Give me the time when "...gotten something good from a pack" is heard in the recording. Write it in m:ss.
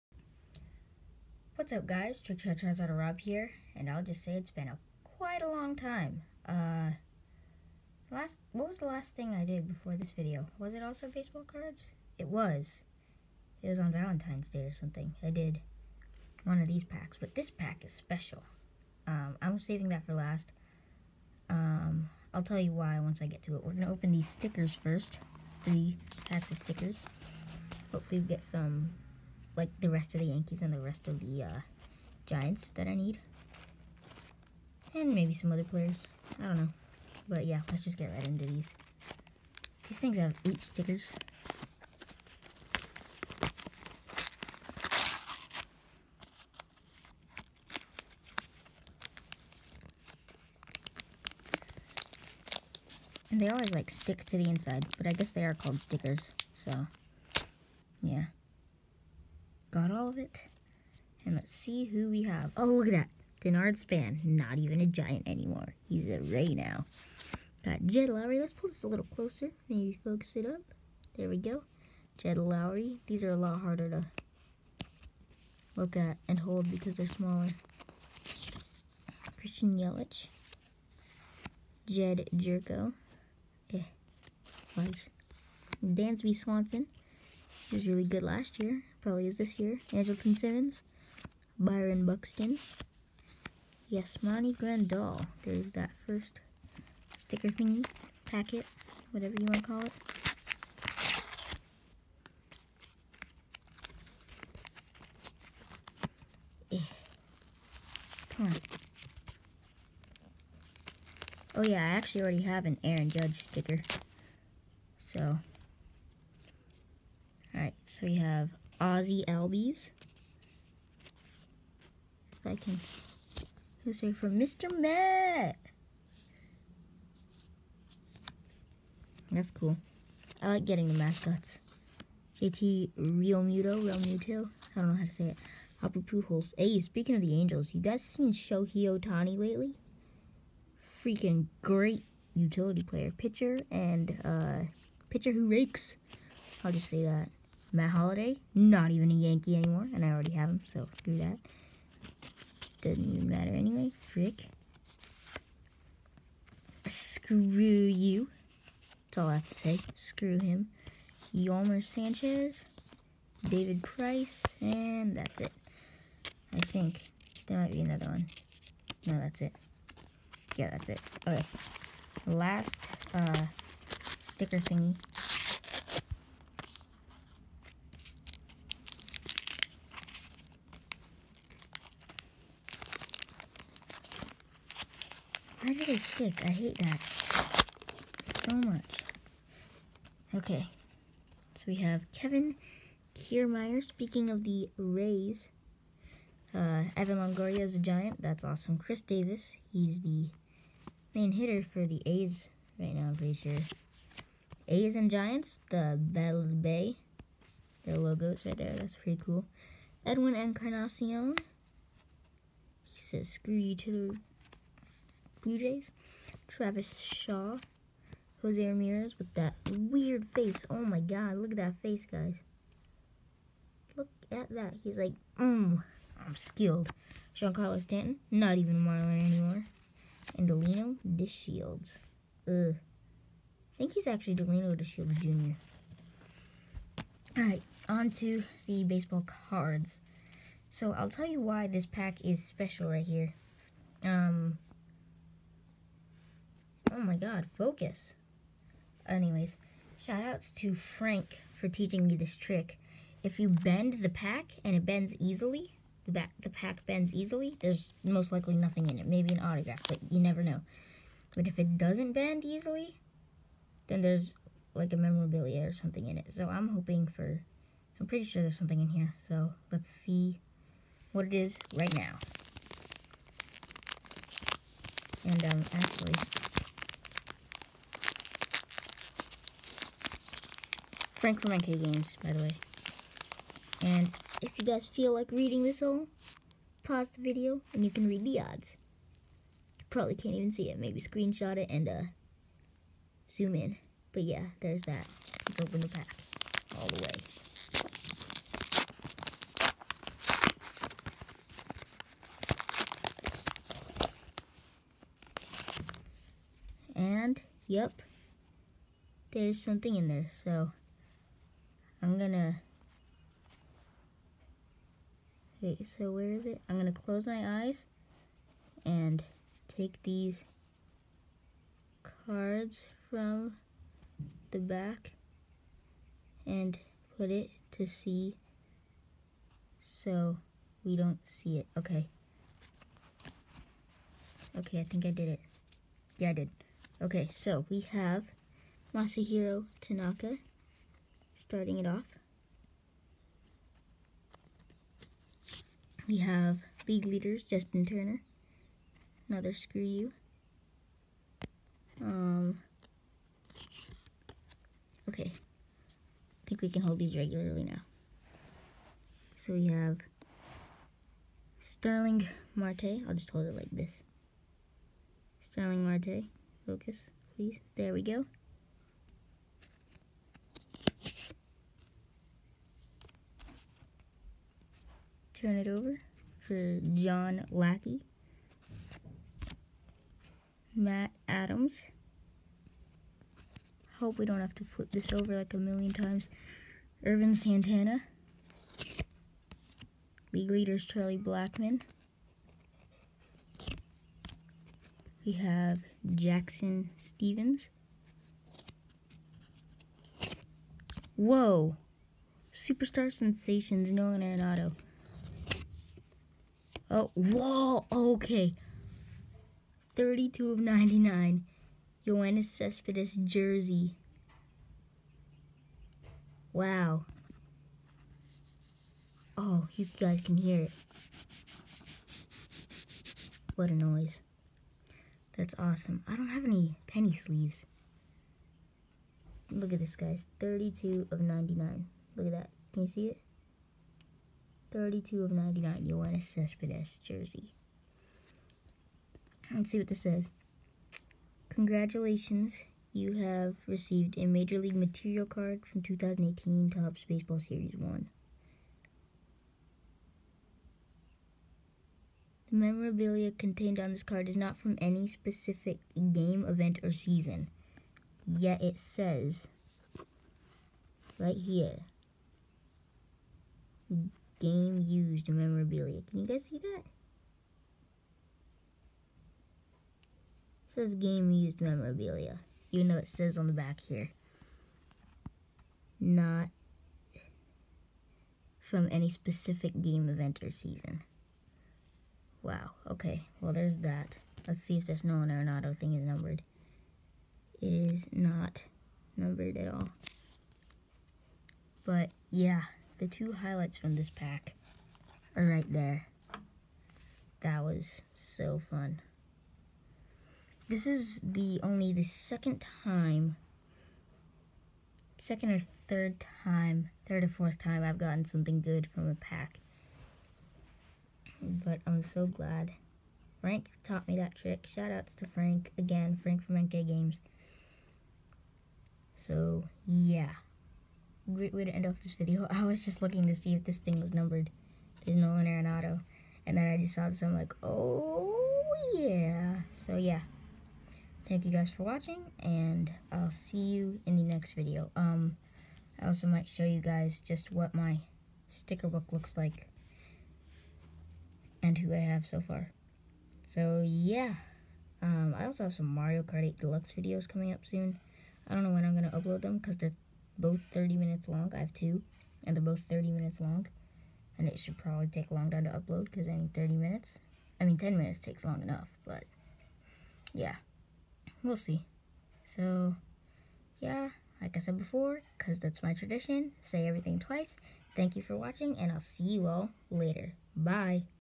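8:27.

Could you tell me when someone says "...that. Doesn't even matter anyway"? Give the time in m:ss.
2:31.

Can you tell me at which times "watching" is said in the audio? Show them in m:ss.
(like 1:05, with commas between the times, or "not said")
8:51, 9:28.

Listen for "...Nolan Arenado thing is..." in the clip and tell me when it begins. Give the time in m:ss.
8:05.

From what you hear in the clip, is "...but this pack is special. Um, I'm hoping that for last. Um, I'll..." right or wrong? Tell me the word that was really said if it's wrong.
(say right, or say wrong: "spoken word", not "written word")
wrong: "saving", not "hoping".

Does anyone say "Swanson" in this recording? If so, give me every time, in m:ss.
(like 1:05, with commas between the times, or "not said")
1:26.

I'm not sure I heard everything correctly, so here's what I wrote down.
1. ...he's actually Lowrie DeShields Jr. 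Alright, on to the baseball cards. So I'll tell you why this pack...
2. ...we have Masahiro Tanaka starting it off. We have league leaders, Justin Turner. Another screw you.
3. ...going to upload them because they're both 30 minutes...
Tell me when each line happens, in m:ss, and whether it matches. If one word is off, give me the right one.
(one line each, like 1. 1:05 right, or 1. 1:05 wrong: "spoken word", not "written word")
1. 3:53 wrong: "Delino", not "Lowrie"
2. 5:37 right
3. 9:08 right.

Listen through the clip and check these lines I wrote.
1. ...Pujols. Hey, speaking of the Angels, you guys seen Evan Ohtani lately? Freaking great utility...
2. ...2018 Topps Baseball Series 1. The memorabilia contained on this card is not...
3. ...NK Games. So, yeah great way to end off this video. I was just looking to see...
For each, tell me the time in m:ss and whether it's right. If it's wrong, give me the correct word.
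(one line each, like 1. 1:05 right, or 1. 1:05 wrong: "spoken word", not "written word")
1. 2:15 wrong: "Shohei", not "Evan"
2. 7:25 right
3. 8:36 right.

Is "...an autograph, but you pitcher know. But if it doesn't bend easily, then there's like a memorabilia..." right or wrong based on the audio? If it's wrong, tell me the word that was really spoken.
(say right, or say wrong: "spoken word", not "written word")
wrong: "never", not "pitcher".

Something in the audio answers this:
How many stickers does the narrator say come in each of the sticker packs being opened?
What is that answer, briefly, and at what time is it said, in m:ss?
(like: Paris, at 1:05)
8, at 0:40.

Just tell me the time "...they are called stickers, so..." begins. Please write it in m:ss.
0:55.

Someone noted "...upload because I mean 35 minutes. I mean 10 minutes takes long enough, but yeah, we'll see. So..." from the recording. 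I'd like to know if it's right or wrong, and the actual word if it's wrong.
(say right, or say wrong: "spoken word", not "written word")
wrong: "30", not "35".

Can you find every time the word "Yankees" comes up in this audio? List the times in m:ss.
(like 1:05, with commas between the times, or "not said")
0:30, 2:29.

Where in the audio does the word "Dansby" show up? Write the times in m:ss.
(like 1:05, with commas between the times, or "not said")
1:25.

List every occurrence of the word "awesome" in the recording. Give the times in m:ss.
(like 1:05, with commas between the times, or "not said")
3:18, 7:05.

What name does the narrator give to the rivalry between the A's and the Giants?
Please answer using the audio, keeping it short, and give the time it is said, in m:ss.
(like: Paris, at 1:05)
Battle of the Bay, at 3:25.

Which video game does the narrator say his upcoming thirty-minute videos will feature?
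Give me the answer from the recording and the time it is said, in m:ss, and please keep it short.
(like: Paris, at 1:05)
Mario Kart 8 Deluxe, at 9:05.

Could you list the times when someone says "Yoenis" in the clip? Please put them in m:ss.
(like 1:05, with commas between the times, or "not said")
6:52, 7:15.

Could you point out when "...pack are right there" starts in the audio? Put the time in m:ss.
8:14.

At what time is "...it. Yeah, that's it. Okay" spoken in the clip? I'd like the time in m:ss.
2:49.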